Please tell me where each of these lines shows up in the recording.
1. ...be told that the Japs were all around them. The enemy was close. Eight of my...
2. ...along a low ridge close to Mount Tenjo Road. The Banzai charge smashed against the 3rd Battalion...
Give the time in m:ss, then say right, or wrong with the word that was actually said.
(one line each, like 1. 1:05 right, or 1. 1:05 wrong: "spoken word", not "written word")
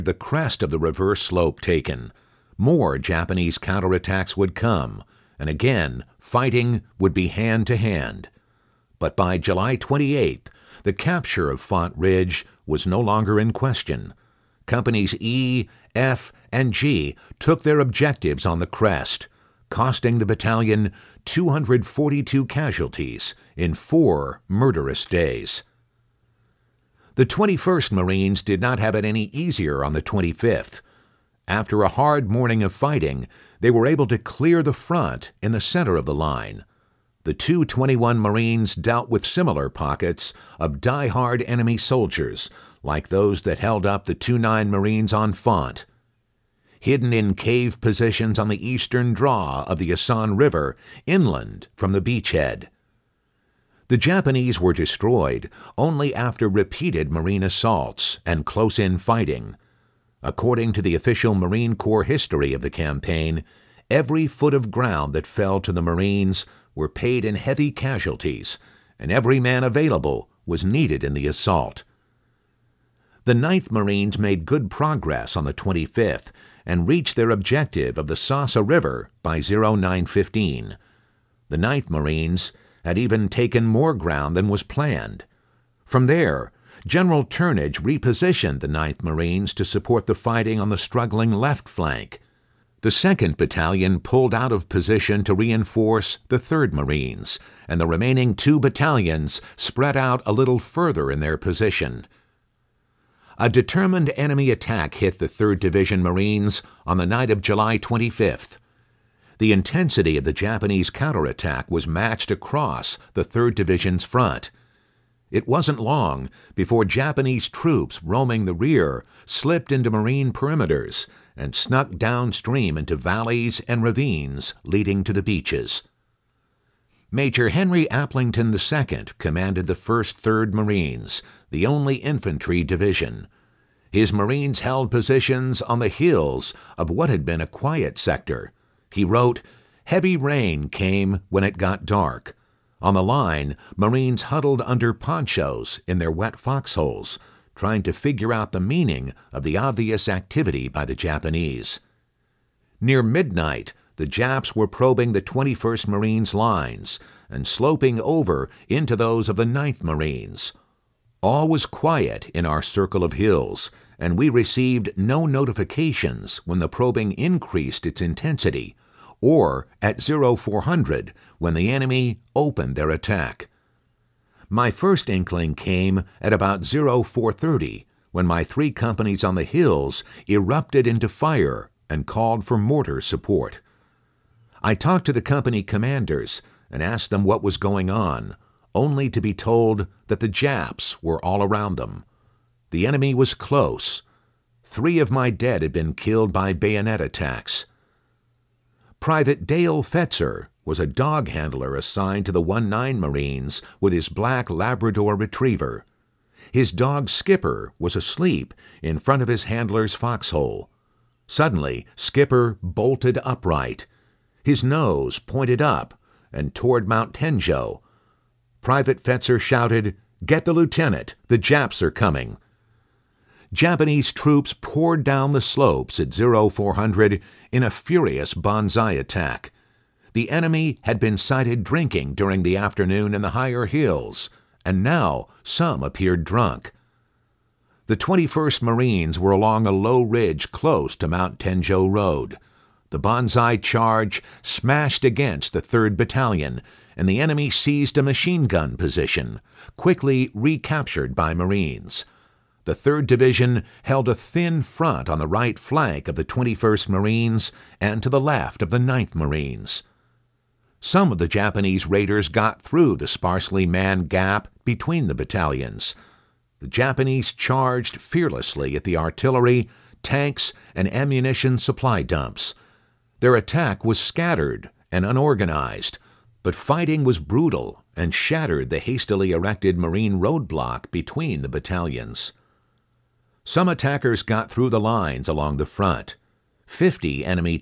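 1. 3:09 wrong: "Three", not "Eight"
2. 3:59 right.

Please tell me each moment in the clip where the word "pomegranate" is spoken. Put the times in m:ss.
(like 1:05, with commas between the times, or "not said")
not said.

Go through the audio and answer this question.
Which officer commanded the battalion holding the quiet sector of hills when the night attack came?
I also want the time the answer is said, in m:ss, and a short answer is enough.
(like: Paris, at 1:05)
Henry Aplington II, at 2:07.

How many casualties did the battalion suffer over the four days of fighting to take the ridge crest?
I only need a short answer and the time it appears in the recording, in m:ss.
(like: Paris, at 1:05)
242, at 0:21.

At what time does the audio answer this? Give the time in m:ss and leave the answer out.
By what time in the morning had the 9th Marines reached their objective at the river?
1:19.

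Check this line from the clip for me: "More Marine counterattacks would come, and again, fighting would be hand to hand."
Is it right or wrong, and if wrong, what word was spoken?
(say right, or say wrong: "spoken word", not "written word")
wrong: "Japanese", not "Marine".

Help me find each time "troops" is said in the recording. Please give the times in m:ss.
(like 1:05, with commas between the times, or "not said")
1:57, 3:44.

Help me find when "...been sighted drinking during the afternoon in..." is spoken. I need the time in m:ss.
3:50.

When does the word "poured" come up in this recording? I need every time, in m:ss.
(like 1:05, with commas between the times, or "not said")
3:44.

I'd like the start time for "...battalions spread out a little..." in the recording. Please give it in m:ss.
1:38.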